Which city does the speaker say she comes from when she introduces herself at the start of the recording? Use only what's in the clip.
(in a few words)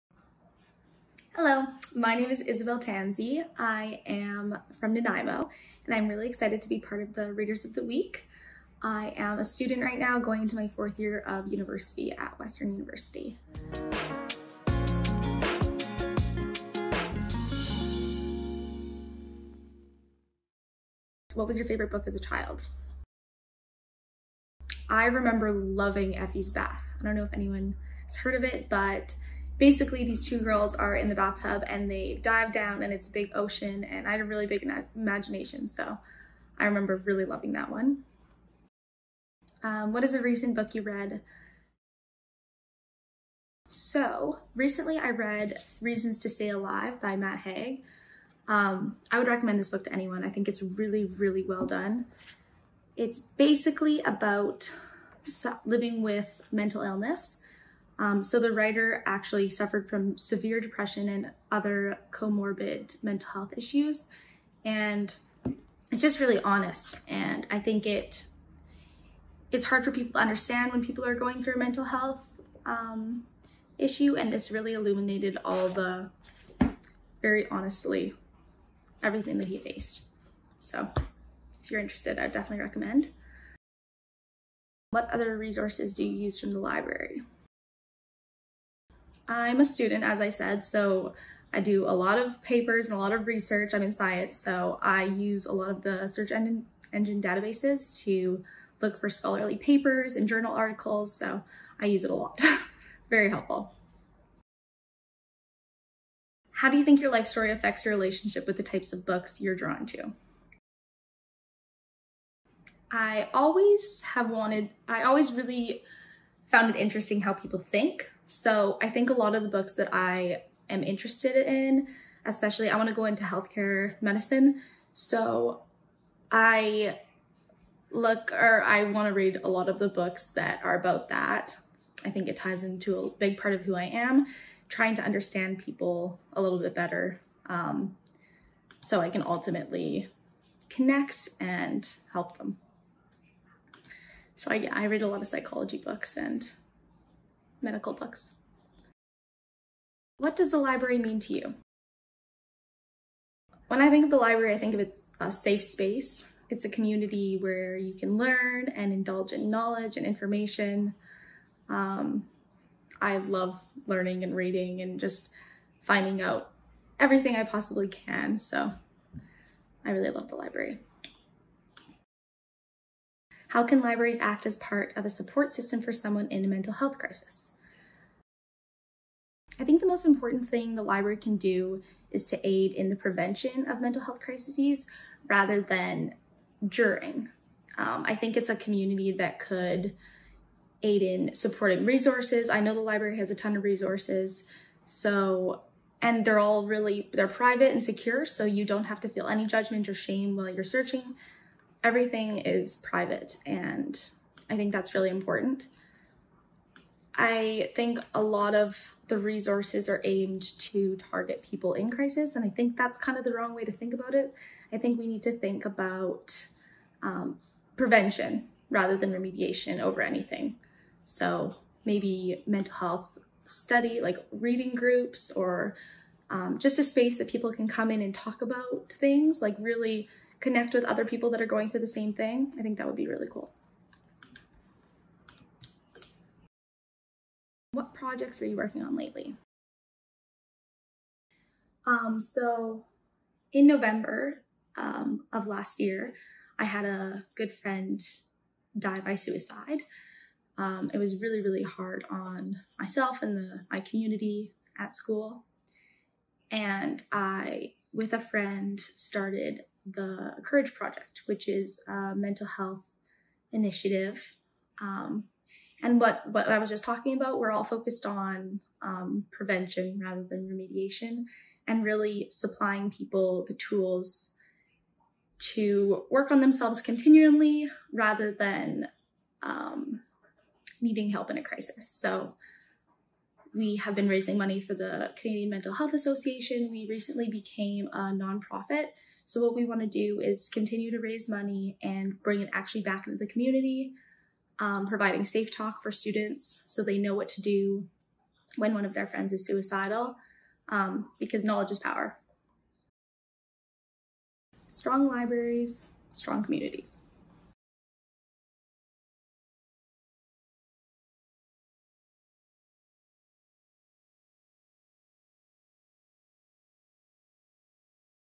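Nanaimo.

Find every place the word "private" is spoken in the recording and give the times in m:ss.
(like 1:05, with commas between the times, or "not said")
3:17, 3:22.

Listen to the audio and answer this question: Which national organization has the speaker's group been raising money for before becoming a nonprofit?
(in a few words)
Canadian Mental Health Association.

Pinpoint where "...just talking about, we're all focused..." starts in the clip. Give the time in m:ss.
4:26.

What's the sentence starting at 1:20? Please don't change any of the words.
So if you're interested, I definitely recommend.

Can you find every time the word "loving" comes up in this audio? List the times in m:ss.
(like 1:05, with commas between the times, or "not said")
0:25, 0:37.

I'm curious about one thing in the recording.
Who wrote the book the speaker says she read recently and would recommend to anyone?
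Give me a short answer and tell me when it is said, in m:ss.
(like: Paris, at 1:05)
Matt Haig, at 0:47.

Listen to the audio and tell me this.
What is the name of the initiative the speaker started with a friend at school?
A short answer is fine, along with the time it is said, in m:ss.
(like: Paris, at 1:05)
Courage Project, at 4:20.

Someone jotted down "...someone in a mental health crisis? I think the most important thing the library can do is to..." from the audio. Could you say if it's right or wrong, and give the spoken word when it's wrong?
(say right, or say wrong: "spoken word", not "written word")
right.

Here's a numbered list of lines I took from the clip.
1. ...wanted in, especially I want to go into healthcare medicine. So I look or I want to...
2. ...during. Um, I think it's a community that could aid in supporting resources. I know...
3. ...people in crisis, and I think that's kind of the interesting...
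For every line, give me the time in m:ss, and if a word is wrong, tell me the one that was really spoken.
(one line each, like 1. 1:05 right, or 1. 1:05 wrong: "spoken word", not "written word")
1. 2:00 wrong: "interested", not "wanted"
2. 3:06 right
3. 3:31 wrong: "wrong", not "interesting".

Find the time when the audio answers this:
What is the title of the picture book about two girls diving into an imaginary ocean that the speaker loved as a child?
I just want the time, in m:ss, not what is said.
0:26.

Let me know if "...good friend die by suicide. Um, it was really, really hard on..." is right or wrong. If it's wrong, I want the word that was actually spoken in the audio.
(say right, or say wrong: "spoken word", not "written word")
right.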